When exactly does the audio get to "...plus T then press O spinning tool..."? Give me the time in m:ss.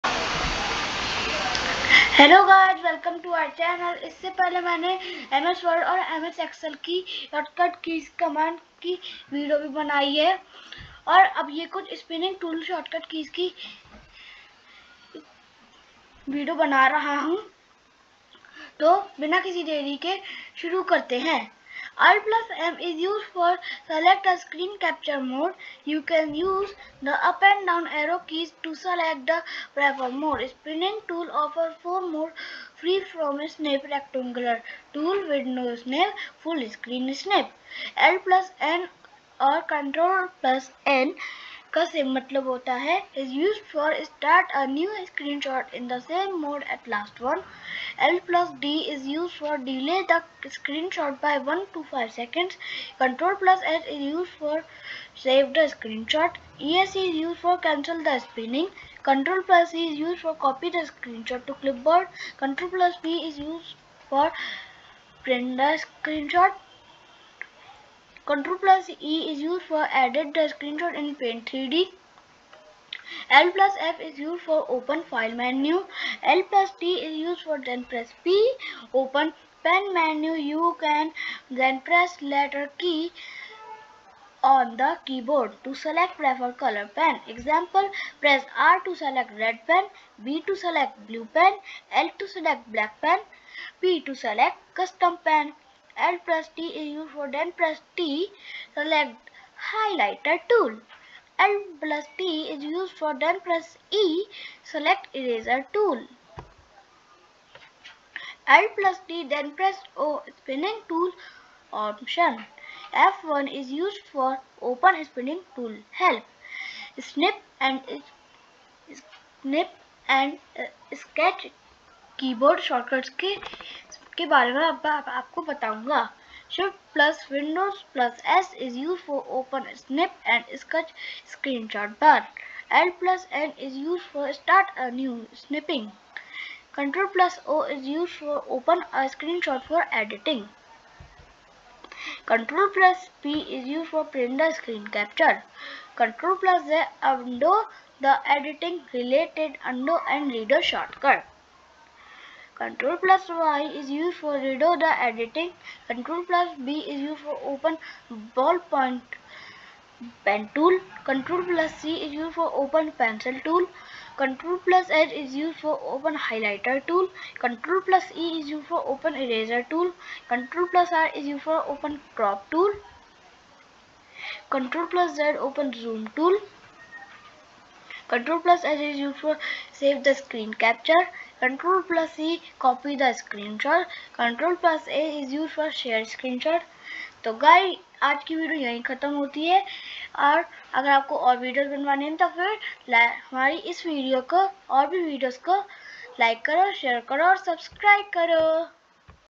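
1:48.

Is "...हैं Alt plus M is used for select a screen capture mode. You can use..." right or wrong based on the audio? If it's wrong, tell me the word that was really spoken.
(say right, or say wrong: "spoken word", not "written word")
right.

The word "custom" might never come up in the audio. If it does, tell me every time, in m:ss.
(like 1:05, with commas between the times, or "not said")
1:34.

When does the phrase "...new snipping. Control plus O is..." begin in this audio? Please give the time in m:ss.
2:14.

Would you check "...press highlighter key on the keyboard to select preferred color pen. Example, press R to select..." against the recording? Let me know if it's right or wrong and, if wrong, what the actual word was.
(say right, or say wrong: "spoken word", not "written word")
wrong: "letter", not "highlighter".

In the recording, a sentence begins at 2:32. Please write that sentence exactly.
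Control plus Y is used for redo the editing.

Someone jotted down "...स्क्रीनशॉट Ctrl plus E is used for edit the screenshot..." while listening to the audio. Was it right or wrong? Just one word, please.
right.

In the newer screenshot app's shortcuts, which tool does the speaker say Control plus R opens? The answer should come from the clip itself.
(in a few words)
crop tool.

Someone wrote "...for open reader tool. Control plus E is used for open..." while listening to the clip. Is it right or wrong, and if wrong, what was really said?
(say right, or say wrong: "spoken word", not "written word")
wrong: "highlighter", not "reader".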